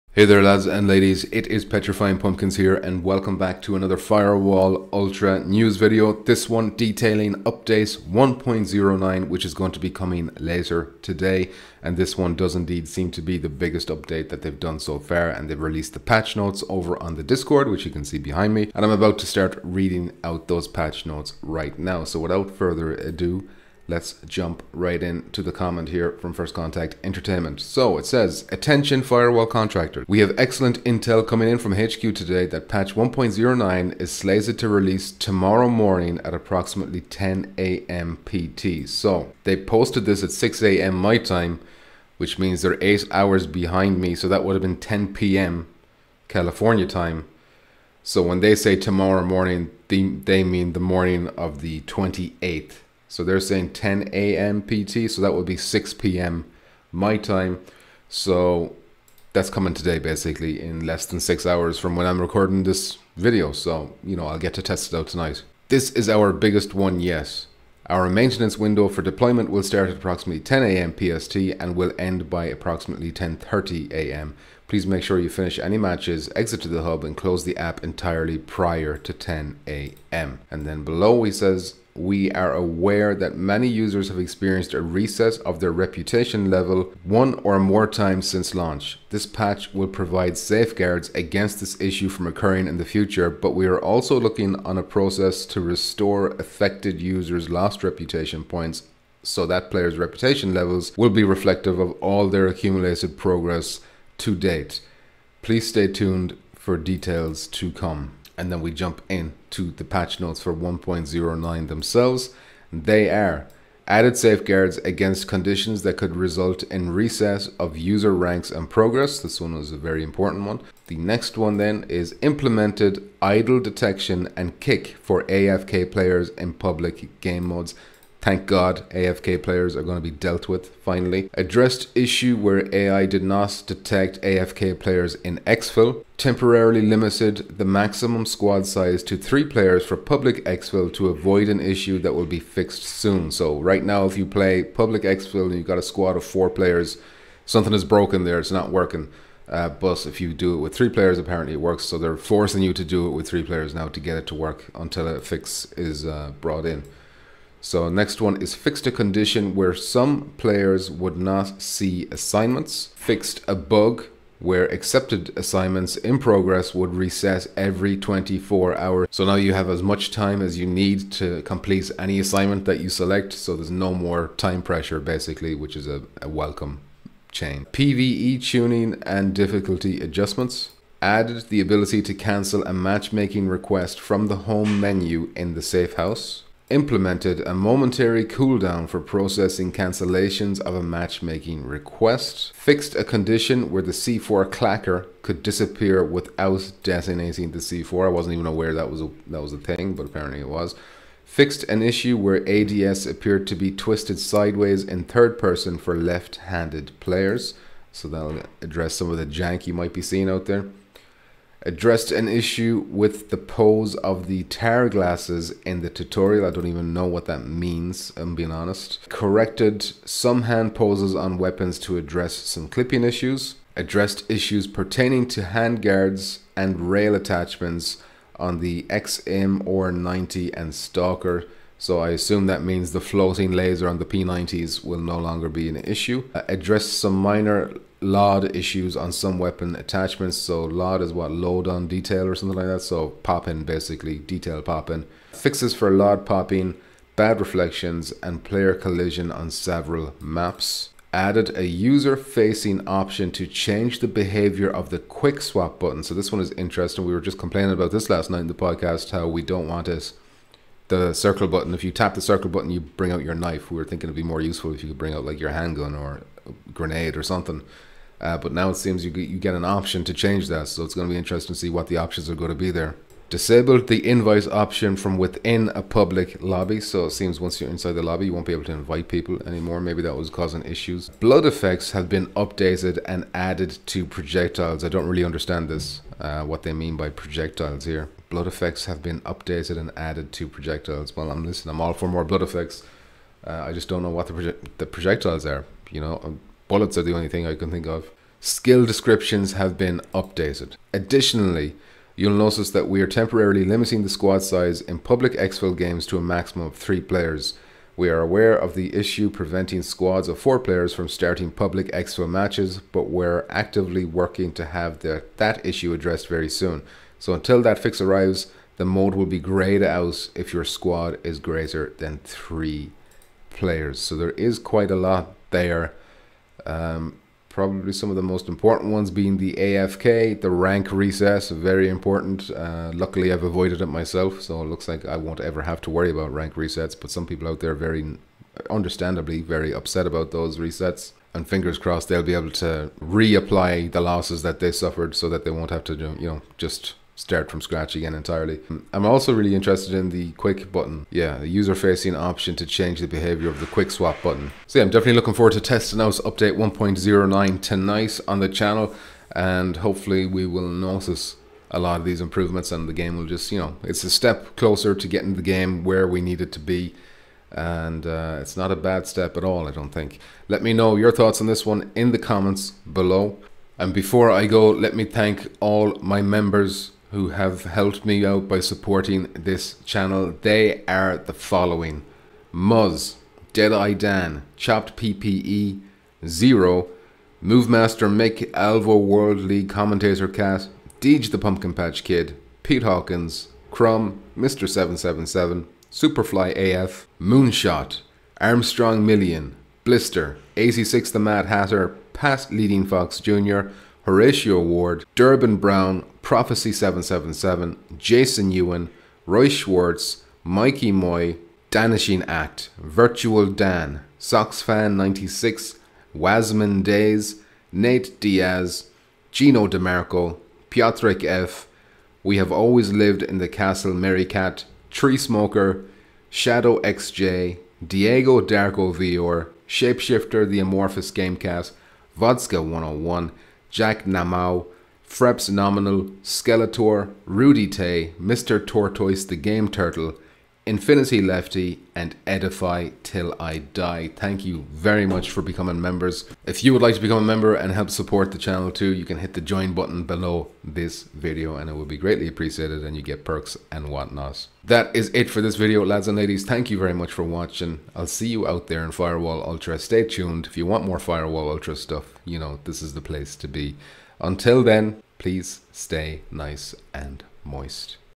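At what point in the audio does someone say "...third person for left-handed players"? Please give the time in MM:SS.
03:25.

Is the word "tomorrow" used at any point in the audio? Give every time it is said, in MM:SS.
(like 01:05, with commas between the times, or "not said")
00:35, 00:48.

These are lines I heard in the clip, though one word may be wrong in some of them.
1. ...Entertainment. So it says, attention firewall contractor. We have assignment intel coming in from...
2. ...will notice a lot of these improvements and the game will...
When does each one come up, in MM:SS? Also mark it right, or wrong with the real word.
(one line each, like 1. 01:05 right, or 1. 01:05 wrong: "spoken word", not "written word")
1. 00:27 wrong: "excellent", not "assignment"
2. 06:00 right.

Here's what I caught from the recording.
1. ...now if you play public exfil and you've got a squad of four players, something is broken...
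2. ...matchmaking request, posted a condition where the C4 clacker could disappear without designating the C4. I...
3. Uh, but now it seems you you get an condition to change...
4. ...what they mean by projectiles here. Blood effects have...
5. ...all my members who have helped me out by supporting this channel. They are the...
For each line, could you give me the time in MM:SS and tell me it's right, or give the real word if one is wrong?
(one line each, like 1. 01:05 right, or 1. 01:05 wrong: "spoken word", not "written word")
1. 02:23 right
2. 03:10 wrong: "fixed", not "posted"
3. 04:28 wrong: "option", not "condition"
4. 04:46 right
5. 06:15 right.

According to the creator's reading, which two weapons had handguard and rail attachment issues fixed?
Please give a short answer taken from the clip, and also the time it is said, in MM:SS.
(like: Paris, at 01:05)
XM or 90 and Stalker, at 03:48.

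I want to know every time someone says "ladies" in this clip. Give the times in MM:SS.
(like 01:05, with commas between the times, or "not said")
00:00, 07:36.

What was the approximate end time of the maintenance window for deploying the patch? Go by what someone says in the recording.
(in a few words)
10:30 a.m.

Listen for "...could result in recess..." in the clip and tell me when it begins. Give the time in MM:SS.
01:55.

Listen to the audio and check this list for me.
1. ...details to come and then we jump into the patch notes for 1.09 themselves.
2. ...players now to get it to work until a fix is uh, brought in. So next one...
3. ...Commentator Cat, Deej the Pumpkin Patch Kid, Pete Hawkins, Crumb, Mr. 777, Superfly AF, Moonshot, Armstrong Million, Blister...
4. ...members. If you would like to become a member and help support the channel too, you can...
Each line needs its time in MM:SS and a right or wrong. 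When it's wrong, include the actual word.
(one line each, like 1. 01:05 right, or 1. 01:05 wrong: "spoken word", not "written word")
1. 01:46 right
2. 02:33 right
3. 06:29 right
4. 07:25 right.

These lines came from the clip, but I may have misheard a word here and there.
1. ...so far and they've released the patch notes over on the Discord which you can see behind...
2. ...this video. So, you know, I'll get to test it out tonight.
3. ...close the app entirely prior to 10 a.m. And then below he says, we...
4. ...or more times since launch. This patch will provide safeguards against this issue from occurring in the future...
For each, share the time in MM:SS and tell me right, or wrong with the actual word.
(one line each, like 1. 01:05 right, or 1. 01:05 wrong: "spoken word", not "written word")
1. 00:14 right
2. 01:02 right
3. 01:17 right
4. 01:27 right.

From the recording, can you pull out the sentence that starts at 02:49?
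So now you have as much time as you need to complete any assignment that you select.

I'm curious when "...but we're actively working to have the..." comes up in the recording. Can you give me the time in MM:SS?
05:12.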